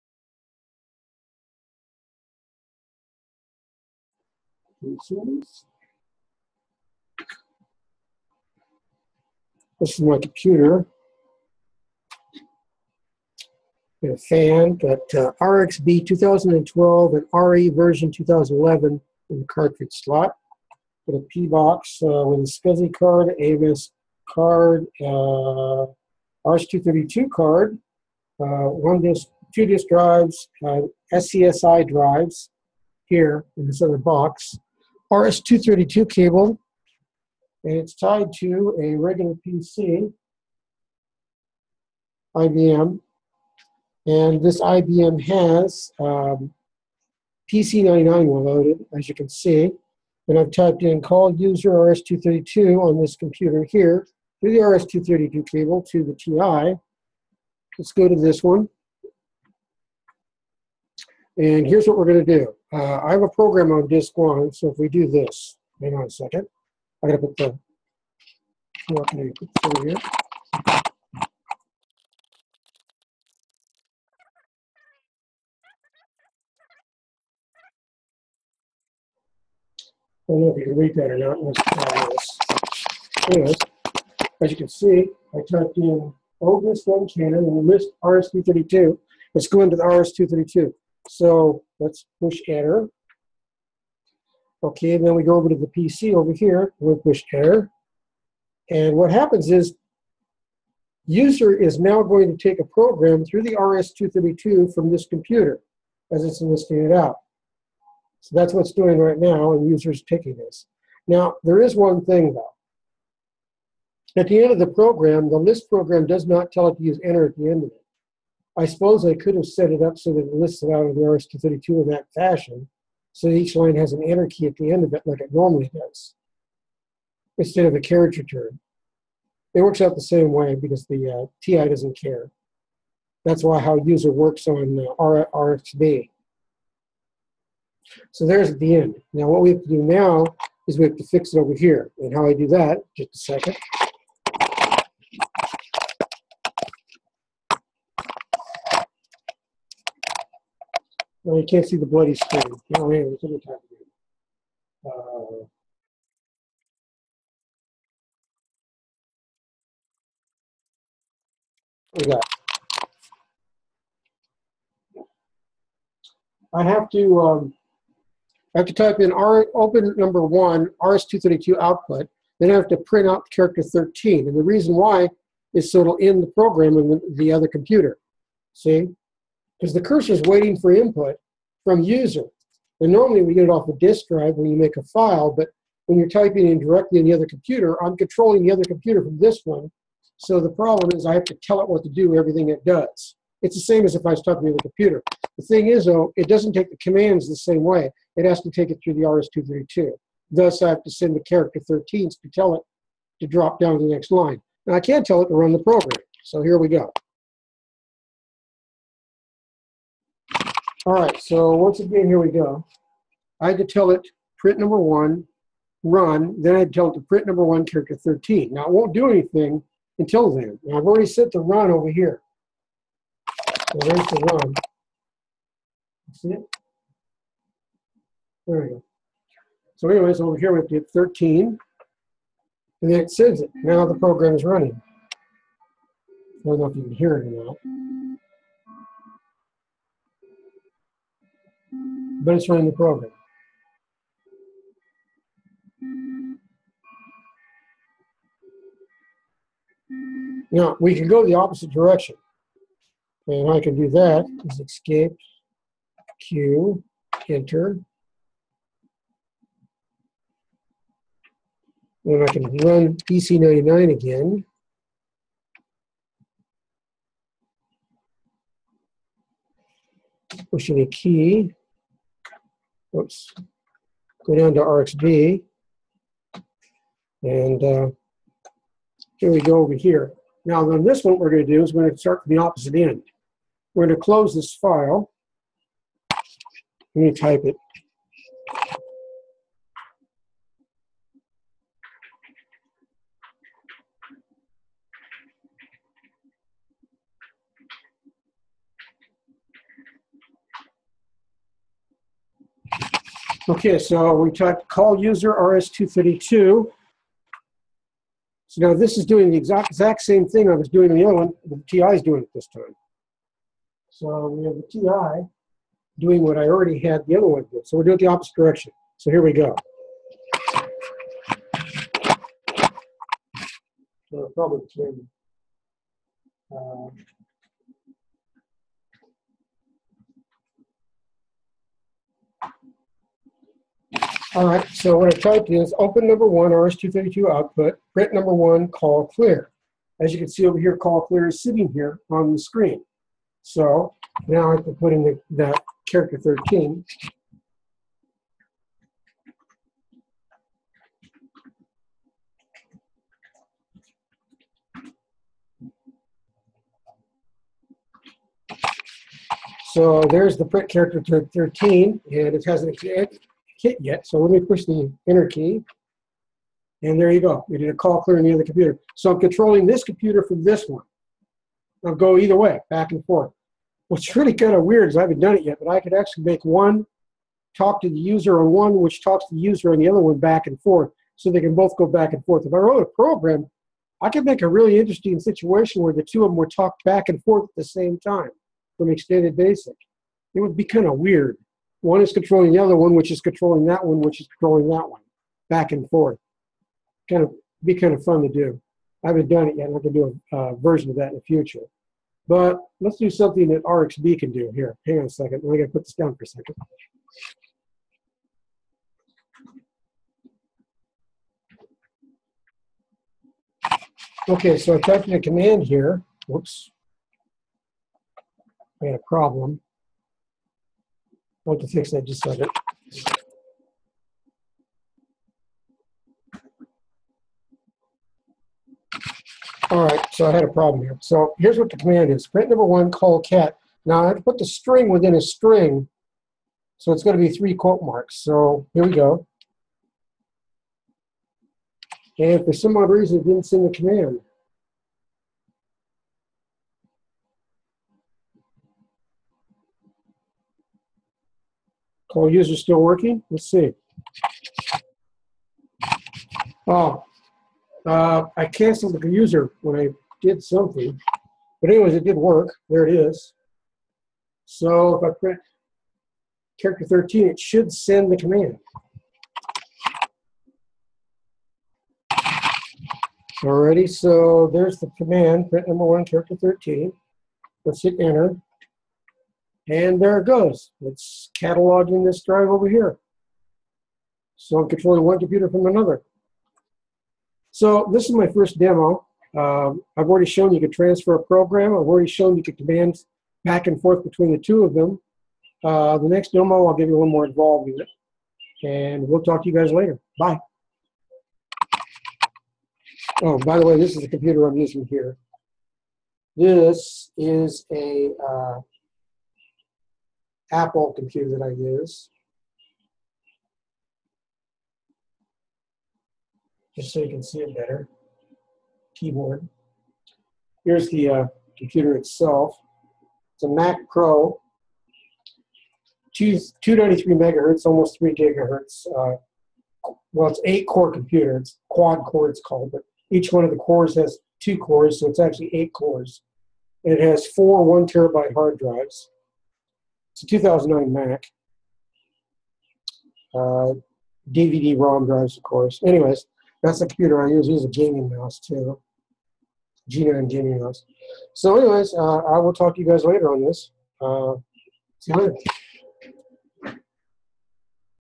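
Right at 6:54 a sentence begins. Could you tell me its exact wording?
Okay, so I typed in a command here.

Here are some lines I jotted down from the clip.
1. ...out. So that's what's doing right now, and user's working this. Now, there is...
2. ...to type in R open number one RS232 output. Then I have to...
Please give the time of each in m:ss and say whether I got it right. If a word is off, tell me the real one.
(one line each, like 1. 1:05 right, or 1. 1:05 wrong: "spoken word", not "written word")
1. 1:46 wrong: "taking", not "working"
2. 2:48 right.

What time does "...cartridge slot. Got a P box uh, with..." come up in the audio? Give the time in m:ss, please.
0:19.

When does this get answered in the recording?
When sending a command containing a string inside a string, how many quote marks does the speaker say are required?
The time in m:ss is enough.
7:17.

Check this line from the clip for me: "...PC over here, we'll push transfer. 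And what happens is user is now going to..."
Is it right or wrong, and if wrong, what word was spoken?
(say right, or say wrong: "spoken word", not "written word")
wrong: "enter", not "transfer".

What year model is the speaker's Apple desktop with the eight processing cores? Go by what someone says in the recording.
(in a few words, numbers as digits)
2009.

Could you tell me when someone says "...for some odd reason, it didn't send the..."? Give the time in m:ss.
7:22.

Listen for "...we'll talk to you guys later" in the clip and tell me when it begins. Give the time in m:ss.
8:19.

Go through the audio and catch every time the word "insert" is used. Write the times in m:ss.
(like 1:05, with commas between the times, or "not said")
not said.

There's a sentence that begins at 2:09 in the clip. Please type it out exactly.
It works out the same way because the uh, TI doesn't care.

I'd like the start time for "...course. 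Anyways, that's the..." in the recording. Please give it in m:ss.
9:05.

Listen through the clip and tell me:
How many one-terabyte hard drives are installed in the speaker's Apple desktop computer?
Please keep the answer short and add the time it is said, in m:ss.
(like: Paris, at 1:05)
4, at 8:57.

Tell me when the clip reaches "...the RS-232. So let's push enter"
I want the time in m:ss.
1:29.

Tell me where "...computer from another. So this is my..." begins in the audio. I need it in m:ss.
8:05.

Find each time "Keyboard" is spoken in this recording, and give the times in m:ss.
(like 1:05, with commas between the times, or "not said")
8:38.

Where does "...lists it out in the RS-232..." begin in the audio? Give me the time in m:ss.
2:00.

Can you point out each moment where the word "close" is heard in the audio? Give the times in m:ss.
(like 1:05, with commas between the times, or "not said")
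4:44.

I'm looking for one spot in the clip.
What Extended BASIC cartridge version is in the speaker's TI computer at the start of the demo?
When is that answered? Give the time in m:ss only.
0:15.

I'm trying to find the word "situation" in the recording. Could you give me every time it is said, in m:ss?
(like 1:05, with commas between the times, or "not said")
6:25.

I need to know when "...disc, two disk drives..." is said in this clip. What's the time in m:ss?
0:29.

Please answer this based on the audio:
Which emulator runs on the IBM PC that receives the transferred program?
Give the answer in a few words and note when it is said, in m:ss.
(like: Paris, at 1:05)
PC99, at 0:47.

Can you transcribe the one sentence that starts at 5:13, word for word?
So we have the TI doing what I already had the other one do.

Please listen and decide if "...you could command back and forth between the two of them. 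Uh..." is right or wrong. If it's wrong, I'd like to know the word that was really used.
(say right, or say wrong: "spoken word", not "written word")
right.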